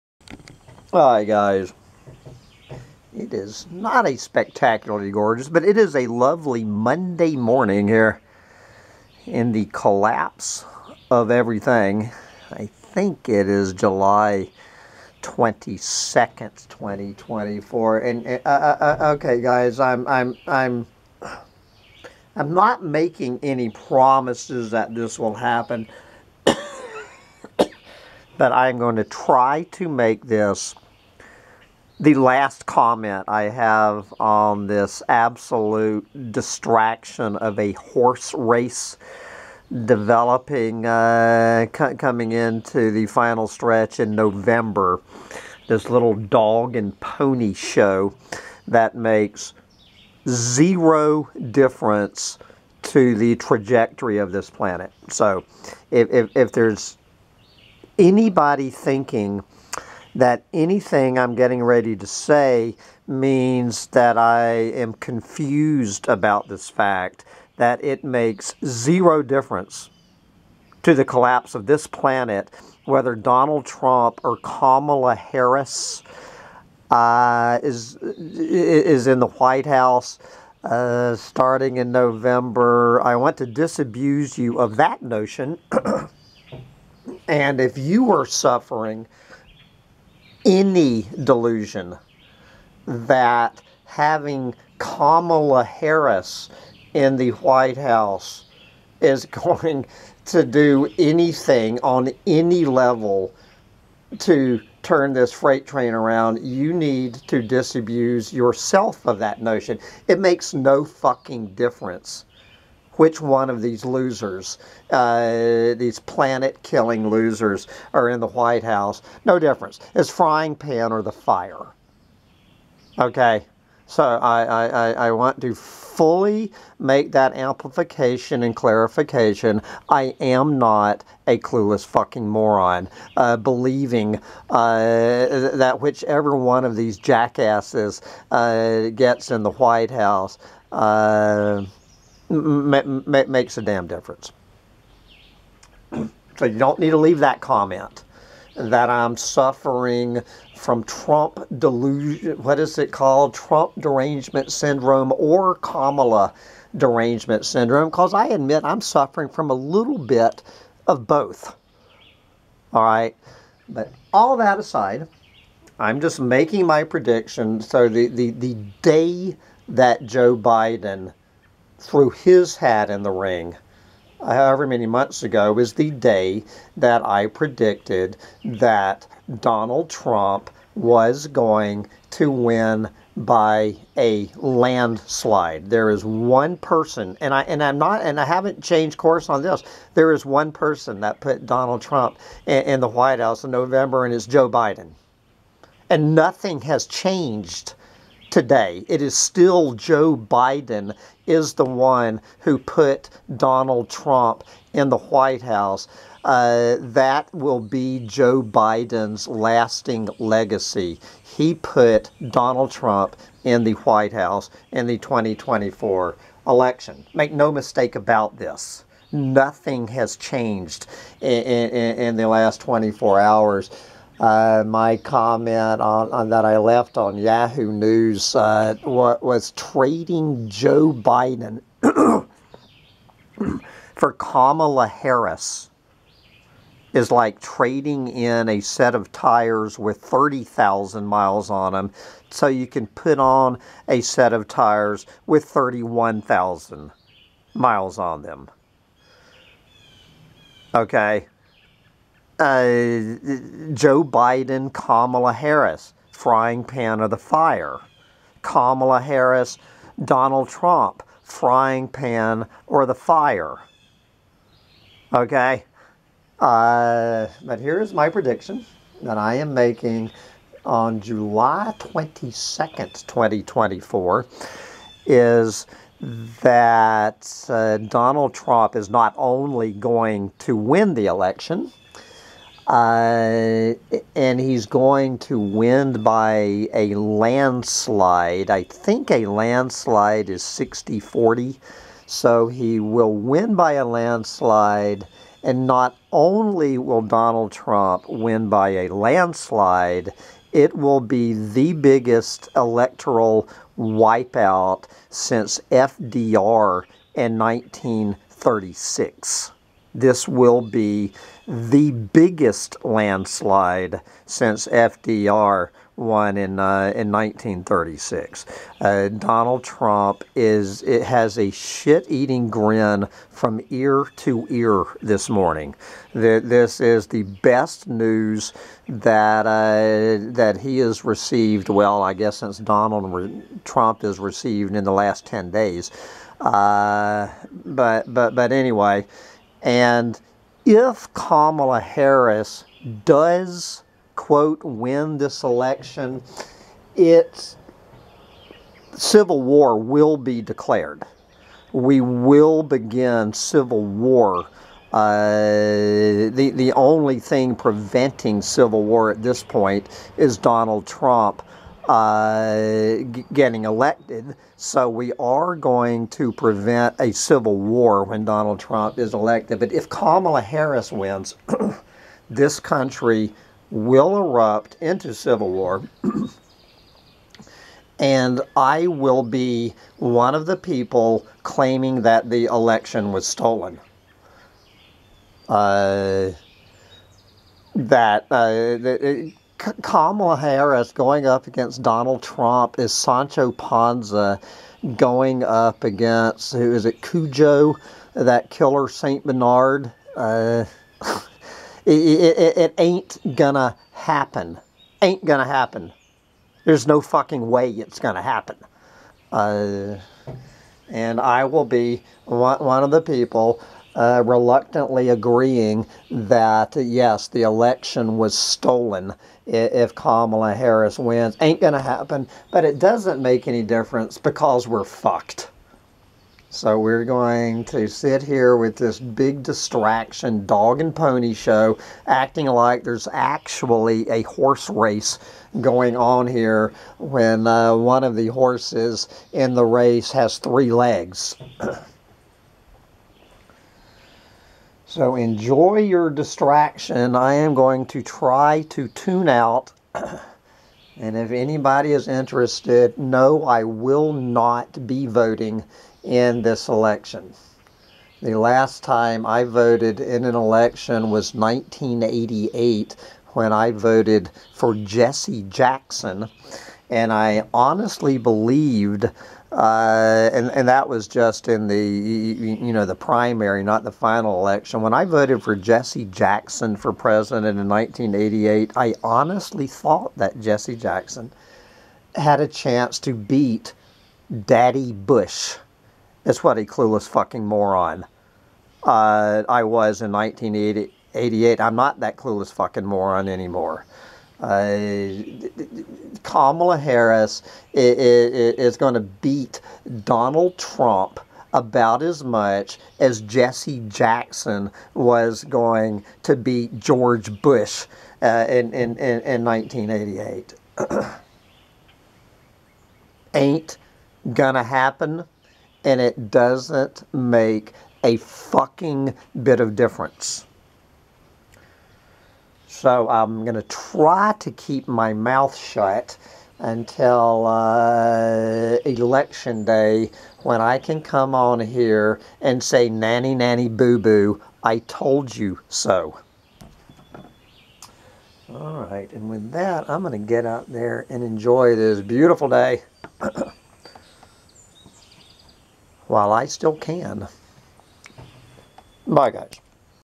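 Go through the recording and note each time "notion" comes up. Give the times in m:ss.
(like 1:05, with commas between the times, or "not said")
1:25, 1:49.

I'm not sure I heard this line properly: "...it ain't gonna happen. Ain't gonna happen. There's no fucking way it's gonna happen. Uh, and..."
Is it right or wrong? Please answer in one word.
right.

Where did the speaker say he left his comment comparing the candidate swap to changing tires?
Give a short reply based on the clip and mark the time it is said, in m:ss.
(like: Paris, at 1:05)
Yahoo News, at 3:47.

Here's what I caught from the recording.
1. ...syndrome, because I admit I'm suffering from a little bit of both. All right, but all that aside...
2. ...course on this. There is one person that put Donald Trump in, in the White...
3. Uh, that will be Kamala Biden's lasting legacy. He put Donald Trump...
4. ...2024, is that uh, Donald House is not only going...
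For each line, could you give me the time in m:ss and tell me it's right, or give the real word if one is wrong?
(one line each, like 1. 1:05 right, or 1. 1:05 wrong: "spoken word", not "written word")
1. 2:37 right
2. 3:08 right
3. 3:26 wrong: "Joe", not "Kamala"
4. 4:33 wrong: "Trump", not "House".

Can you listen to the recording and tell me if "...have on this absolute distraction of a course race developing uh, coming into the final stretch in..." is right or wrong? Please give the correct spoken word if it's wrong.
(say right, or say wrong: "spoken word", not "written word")
wrong: "horse", not "course".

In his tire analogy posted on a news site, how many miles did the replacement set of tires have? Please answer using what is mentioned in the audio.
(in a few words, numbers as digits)
31,000.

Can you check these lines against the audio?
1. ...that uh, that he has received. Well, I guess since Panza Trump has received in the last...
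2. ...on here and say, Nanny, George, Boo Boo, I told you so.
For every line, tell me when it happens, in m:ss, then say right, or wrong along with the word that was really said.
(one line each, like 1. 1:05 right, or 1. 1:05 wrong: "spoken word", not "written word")
1. 5:28 wrong: "Donald", not "Panza"
2. 8:51 wrong: "Nanny", not "George".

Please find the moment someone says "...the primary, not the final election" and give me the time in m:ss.
7:52.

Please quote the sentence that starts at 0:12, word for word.
I think it is July 22nd, 2024.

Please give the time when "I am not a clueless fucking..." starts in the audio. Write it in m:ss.
2:09.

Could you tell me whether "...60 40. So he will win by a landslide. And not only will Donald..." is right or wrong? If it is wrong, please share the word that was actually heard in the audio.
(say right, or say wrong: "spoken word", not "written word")
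right.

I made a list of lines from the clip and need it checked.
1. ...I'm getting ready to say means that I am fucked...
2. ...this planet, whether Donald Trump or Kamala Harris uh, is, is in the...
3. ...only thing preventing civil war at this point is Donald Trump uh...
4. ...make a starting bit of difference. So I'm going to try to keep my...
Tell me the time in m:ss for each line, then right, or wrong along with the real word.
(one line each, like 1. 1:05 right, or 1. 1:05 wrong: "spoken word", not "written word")
1. 1:01 wrong: "confused", not "fucked"
2. 1:11 right
3. 5:56 right
4. 8:37 wrong: "fucking", not "starting".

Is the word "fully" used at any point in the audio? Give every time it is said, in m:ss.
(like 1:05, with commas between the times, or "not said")
2:05.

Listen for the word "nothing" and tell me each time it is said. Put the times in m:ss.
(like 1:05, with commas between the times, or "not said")
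3:16, 3:39.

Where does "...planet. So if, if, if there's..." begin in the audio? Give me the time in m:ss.
0:54.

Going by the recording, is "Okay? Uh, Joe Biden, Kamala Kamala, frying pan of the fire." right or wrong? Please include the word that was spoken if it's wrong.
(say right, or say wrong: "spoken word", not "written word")
wrong: "Harris", not "Kamala".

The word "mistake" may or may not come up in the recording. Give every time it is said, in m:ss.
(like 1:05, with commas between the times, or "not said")
3:37.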